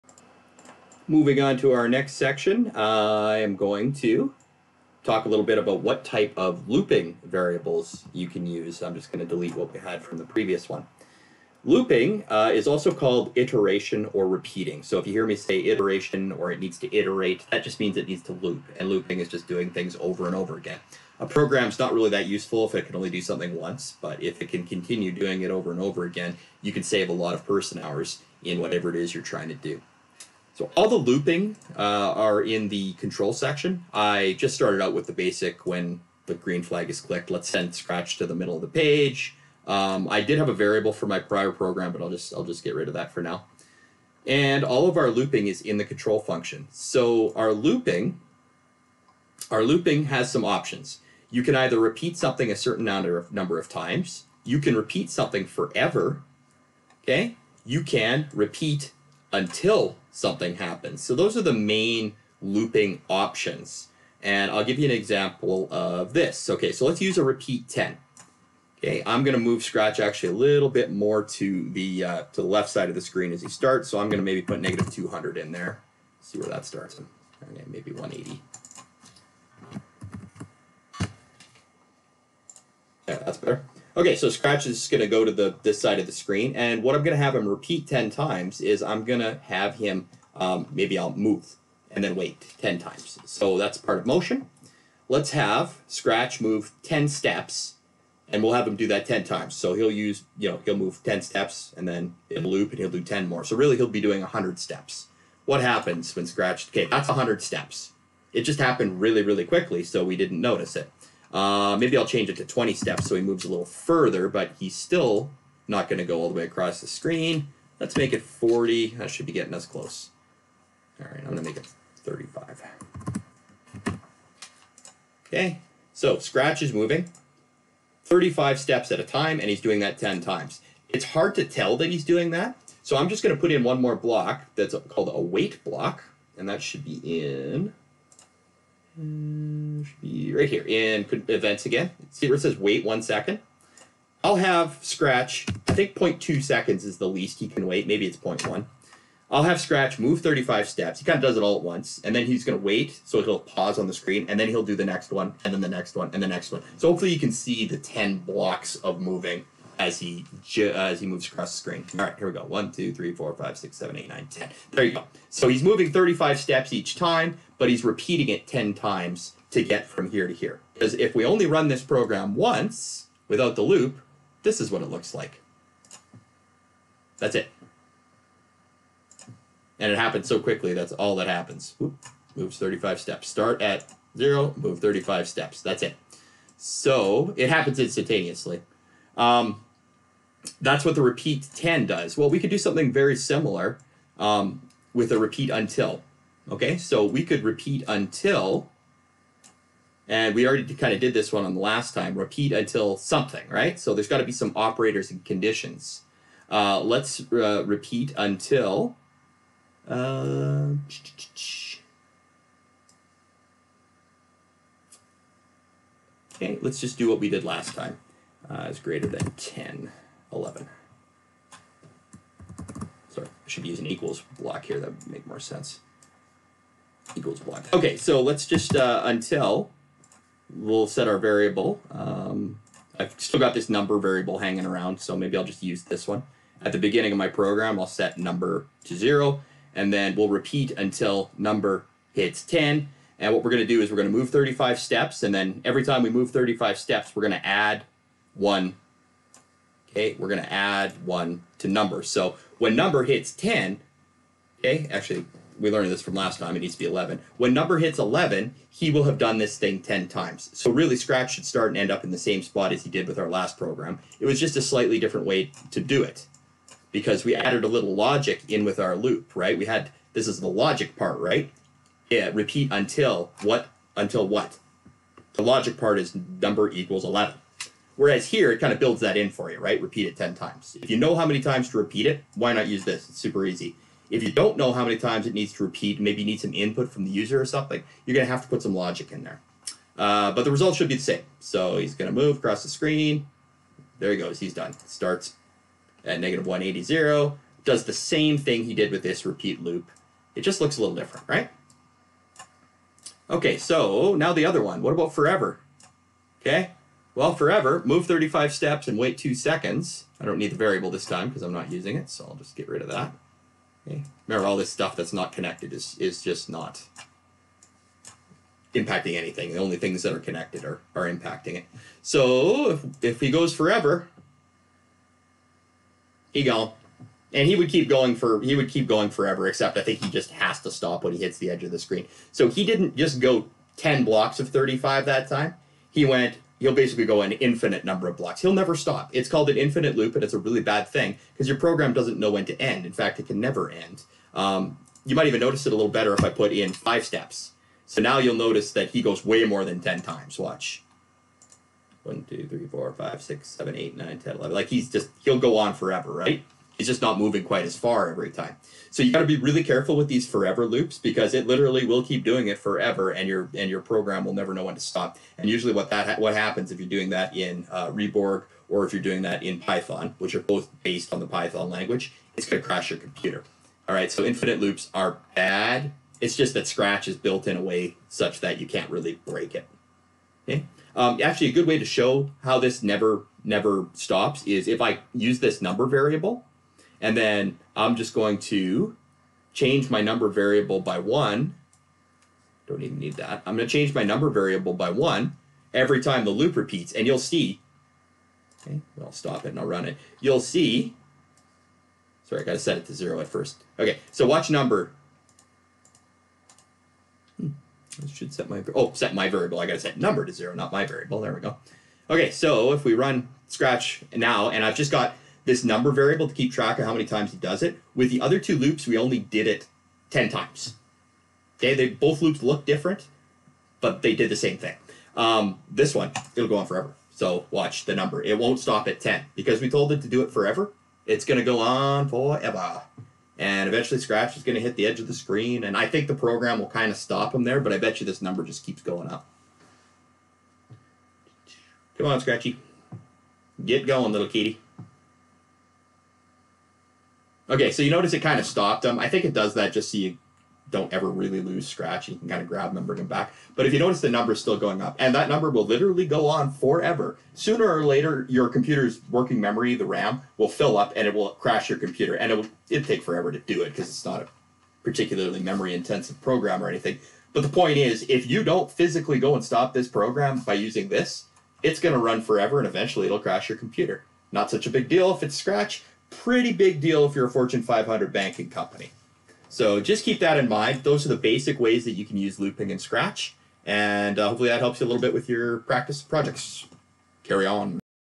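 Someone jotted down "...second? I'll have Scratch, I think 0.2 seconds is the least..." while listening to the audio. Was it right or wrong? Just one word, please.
right.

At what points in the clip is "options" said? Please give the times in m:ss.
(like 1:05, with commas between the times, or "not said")
0:50, 1:03.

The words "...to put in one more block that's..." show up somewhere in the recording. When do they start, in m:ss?
2:13.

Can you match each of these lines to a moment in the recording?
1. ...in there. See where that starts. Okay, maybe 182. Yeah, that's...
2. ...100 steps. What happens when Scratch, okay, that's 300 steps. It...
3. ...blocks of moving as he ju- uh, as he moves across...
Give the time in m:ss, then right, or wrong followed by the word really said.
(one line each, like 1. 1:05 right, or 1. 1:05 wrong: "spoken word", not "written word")
1. 1:15 wrong: "180", not "182"
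2. 1:44 wrong: "100", not "300"
3. 2:38 right.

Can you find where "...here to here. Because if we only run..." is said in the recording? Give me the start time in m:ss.
2:50.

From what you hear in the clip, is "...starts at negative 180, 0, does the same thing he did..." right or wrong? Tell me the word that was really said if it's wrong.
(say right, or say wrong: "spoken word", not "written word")
right.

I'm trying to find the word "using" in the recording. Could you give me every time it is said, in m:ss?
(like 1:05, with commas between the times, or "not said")
5:11, 7:50.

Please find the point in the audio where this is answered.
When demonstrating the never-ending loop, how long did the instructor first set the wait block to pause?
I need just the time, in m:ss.
5:09.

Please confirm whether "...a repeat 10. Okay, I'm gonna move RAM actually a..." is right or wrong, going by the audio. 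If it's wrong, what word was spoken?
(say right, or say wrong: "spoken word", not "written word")
wrong: "Scratch", not "RAM".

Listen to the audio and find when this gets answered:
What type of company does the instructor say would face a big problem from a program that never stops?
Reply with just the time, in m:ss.
7:57.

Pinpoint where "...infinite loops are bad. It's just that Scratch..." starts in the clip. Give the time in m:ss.
6:14.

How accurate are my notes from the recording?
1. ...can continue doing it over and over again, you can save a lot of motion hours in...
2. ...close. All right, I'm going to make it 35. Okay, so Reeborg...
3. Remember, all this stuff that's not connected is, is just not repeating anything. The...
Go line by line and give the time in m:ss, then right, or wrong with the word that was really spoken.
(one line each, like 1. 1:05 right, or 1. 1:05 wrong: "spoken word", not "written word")
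1. 0:24 wrong: "person", not "motion"
2. 1:59 wrong: "Scratch", not "Reeborg"
3. 5:14 wrong: "impacting", not "repeating".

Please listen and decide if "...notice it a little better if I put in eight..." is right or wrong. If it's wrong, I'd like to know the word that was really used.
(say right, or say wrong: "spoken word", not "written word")
wrong: "five", not "eight".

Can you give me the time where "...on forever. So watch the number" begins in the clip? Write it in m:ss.
7:06.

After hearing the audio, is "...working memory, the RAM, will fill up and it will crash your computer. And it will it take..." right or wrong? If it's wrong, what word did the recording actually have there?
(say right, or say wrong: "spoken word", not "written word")
right.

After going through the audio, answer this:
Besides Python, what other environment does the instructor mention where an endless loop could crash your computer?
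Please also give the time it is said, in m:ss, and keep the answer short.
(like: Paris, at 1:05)
Reeborg, at 6:07.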